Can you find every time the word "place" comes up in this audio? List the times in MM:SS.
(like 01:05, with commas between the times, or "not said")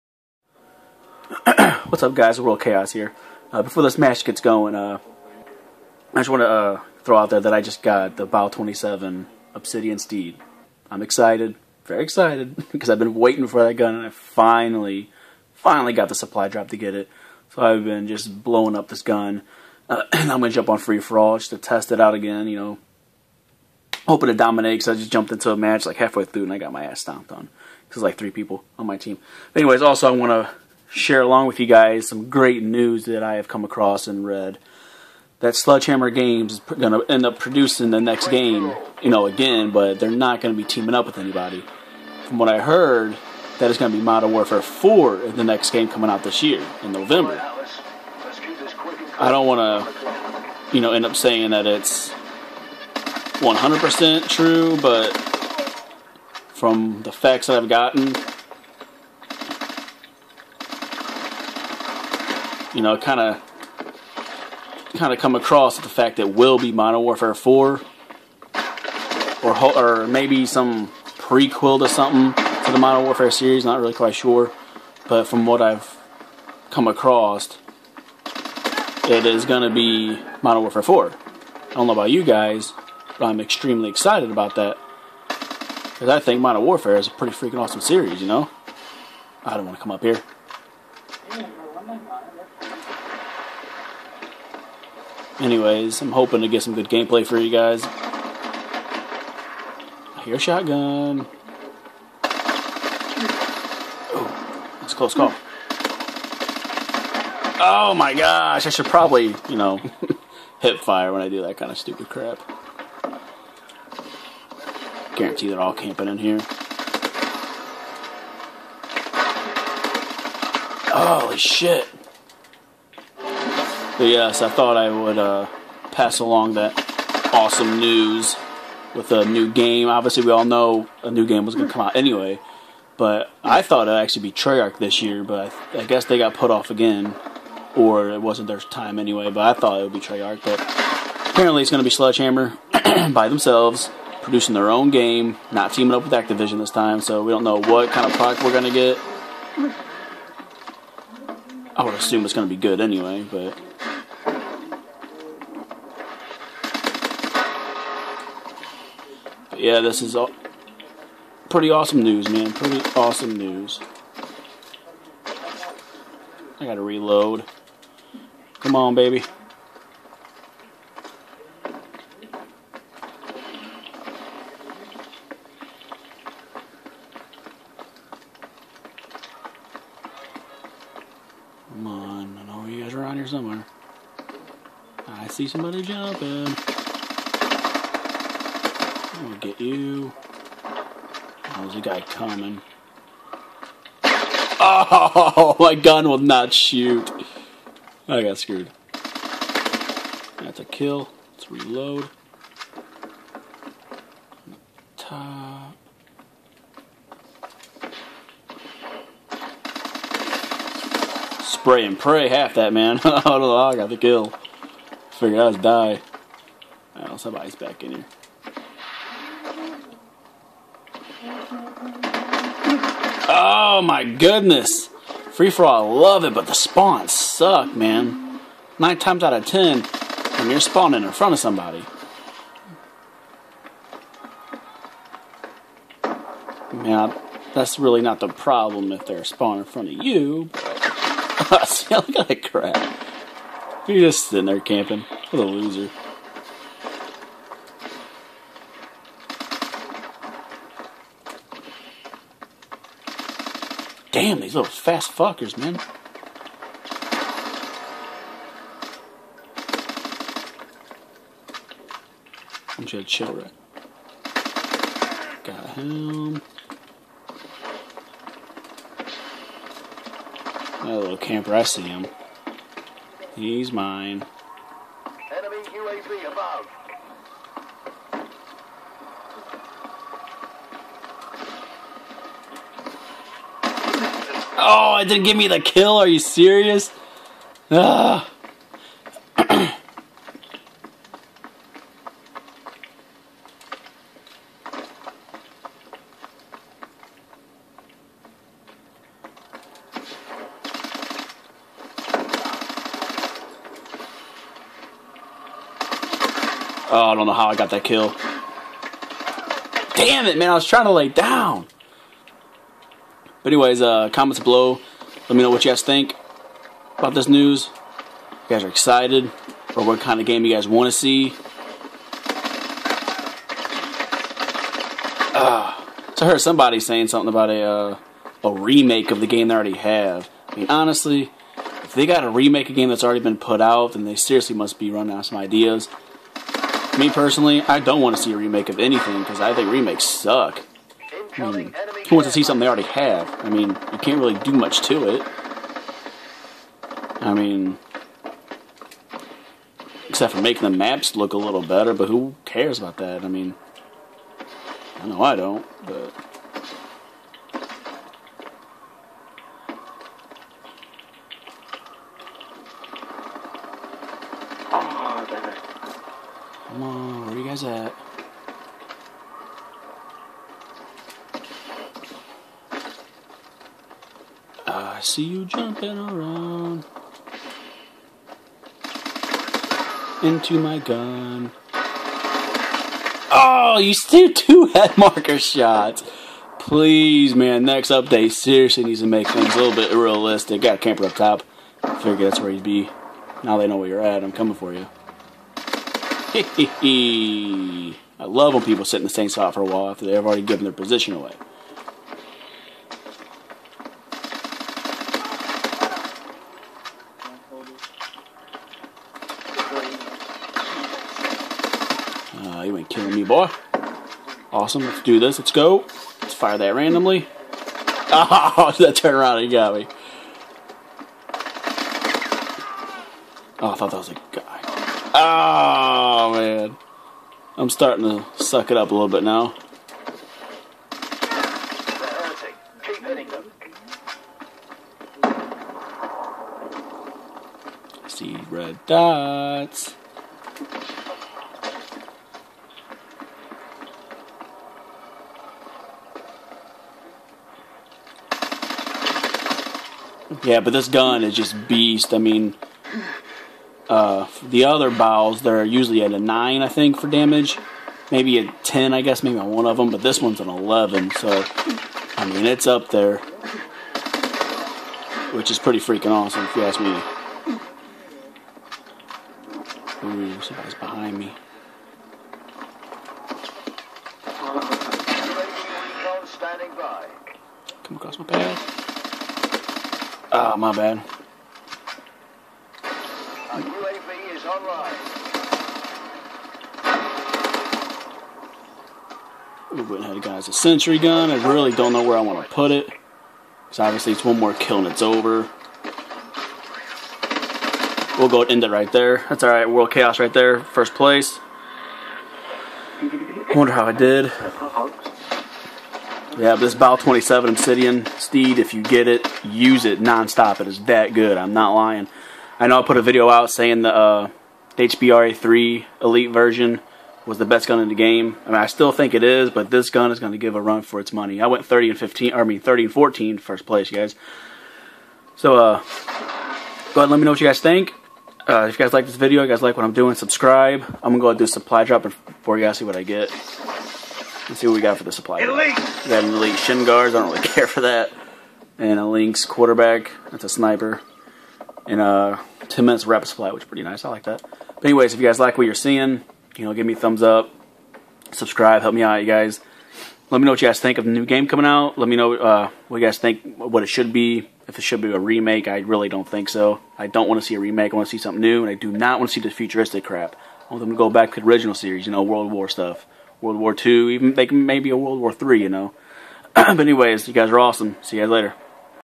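08:20, 08:43.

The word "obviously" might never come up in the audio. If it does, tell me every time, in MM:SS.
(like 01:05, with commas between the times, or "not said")
02:09, 08:13.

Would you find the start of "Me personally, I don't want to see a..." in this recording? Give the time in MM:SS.
05:36.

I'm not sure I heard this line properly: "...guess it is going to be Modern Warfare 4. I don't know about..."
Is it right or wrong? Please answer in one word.
wrong.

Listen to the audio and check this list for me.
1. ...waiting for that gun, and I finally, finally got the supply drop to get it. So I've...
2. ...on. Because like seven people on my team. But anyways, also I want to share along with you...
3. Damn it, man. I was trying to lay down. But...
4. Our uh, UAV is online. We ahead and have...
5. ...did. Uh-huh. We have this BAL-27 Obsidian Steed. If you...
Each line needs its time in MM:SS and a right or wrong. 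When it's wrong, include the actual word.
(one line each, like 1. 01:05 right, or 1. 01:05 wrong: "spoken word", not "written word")
1. 00:13 right
2. 00:27 wrong: "three", not "seven"
3. 05:09 right
4. 08:03 right
5. 08:23 right.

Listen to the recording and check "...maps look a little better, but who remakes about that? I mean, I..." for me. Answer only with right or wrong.
wrong.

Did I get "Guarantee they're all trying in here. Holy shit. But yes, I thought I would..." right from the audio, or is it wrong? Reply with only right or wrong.
wrong.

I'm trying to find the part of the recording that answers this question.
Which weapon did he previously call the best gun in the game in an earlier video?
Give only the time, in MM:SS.
08:34.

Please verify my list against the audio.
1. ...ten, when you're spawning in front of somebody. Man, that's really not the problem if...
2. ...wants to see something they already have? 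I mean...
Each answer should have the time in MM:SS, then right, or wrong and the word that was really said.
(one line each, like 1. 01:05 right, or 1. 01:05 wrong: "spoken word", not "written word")
1. 03:49 right
2. 05:42 right.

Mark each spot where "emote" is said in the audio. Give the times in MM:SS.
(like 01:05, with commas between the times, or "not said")
not said.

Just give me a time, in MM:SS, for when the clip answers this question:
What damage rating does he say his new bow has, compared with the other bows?
07:40.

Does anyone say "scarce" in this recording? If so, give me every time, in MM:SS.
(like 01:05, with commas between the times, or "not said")
not said.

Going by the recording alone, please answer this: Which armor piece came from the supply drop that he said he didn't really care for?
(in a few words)
shin guards.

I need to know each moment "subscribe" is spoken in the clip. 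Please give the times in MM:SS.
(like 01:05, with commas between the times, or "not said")
08:50, 09:08.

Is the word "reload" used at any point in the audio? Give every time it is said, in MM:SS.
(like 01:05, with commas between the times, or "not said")
02:46, 03:21.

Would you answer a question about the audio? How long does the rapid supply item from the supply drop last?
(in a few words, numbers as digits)
10 minutes.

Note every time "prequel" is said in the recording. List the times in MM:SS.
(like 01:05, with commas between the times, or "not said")
01:11.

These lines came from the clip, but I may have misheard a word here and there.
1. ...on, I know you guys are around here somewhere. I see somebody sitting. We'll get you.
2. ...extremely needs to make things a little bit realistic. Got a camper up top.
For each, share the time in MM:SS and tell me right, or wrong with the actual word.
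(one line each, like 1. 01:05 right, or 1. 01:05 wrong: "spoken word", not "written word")
1. 03:01 wrong: "jumping", not "sitting"
2. 06:28 wrong: "seriously", not "extremely".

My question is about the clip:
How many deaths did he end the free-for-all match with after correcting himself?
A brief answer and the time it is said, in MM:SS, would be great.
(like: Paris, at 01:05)
14, at 08:42.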